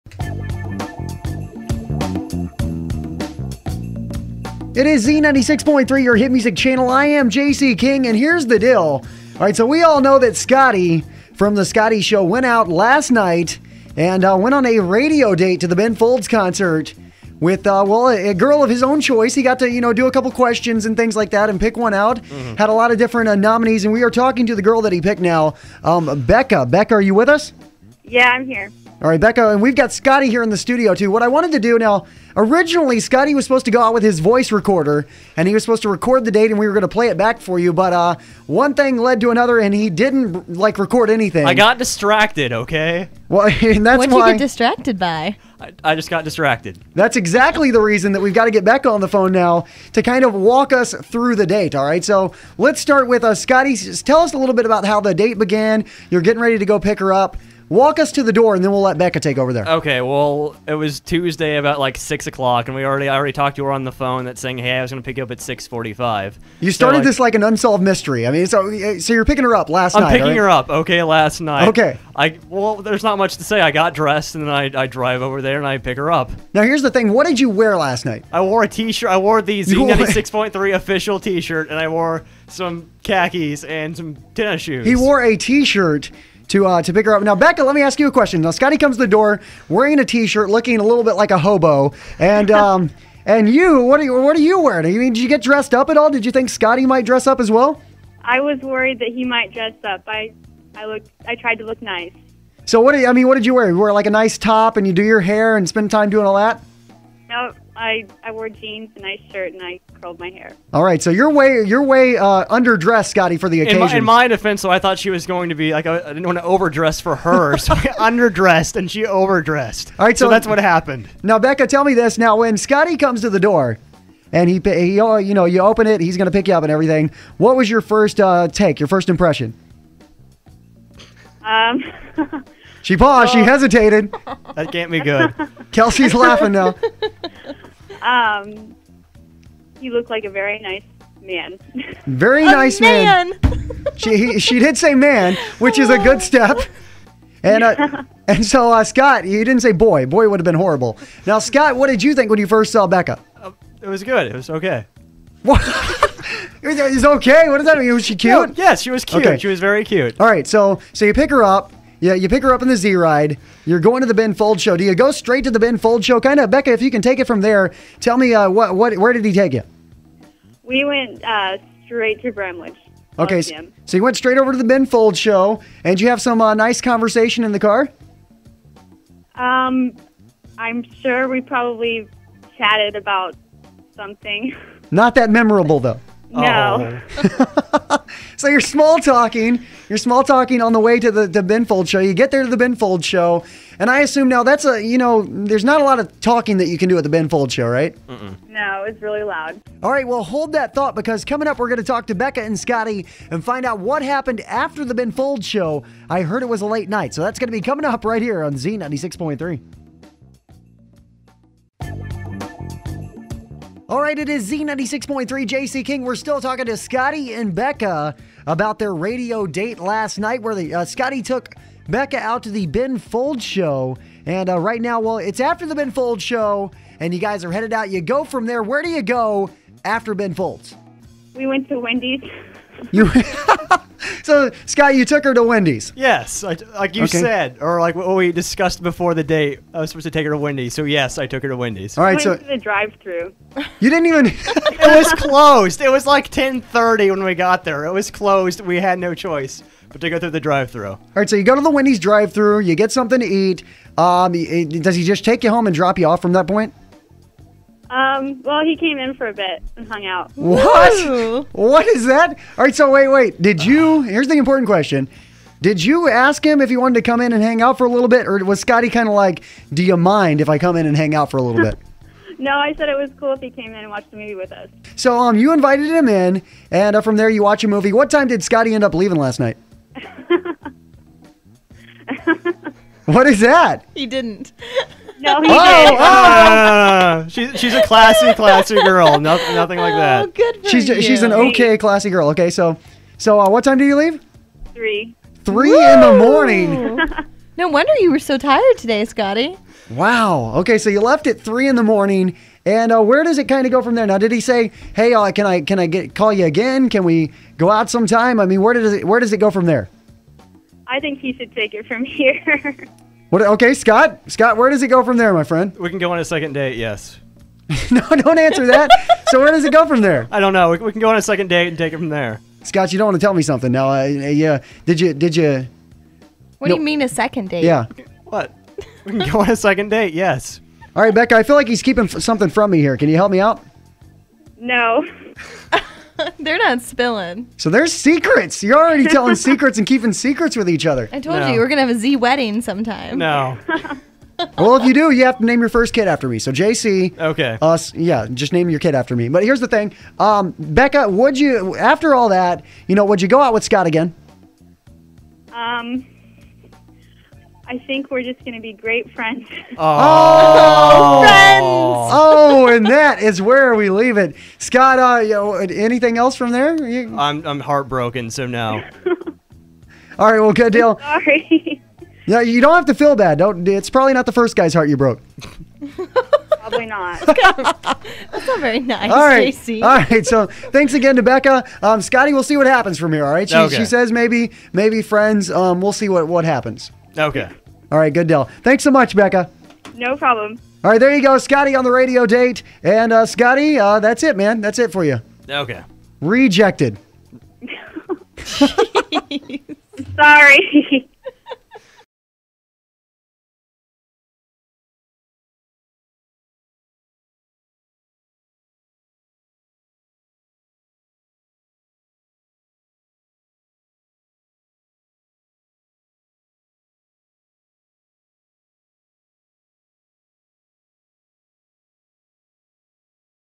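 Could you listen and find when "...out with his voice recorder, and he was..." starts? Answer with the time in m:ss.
0:33.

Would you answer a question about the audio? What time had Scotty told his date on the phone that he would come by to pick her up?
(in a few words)
6:45.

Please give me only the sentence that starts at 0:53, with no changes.
Tell us a little bit about how the date began.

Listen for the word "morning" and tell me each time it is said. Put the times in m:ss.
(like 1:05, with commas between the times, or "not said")
4:56, 5:01.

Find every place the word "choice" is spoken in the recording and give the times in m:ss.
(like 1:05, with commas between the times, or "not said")
0:19, 4:09.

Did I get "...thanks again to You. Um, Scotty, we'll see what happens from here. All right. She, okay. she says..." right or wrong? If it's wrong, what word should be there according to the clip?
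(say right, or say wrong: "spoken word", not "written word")
wrong: "Becca", not "You".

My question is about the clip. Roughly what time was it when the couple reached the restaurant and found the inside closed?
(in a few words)
10:30.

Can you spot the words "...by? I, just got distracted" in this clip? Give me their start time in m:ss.
0:44.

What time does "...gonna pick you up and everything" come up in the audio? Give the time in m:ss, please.
2:06.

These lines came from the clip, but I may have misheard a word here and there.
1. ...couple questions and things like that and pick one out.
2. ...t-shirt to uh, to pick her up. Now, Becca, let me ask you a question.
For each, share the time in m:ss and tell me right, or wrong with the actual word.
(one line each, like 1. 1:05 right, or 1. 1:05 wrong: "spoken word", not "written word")
1. 0:20 right
2. 1:25 right.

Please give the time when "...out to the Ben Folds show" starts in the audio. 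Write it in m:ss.
3:42.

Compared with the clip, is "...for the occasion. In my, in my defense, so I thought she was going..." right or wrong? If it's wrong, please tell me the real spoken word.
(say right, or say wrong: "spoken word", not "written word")
right.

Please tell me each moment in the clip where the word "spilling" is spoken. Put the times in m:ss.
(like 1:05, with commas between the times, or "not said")
5:36.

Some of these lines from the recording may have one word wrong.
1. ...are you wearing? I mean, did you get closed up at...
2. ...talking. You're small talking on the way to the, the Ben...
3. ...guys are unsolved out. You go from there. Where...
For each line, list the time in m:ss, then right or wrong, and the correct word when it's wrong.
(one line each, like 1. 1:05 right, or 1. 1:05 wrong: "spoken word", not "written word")
1. 1:34 wrong: "dressed", not "closed"
2. 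3:08 right
3. 3:47 wrong: "headed", not "unsolved".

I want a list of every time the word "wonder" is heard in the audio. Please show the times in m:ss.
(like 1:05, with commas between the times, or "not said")
4:57.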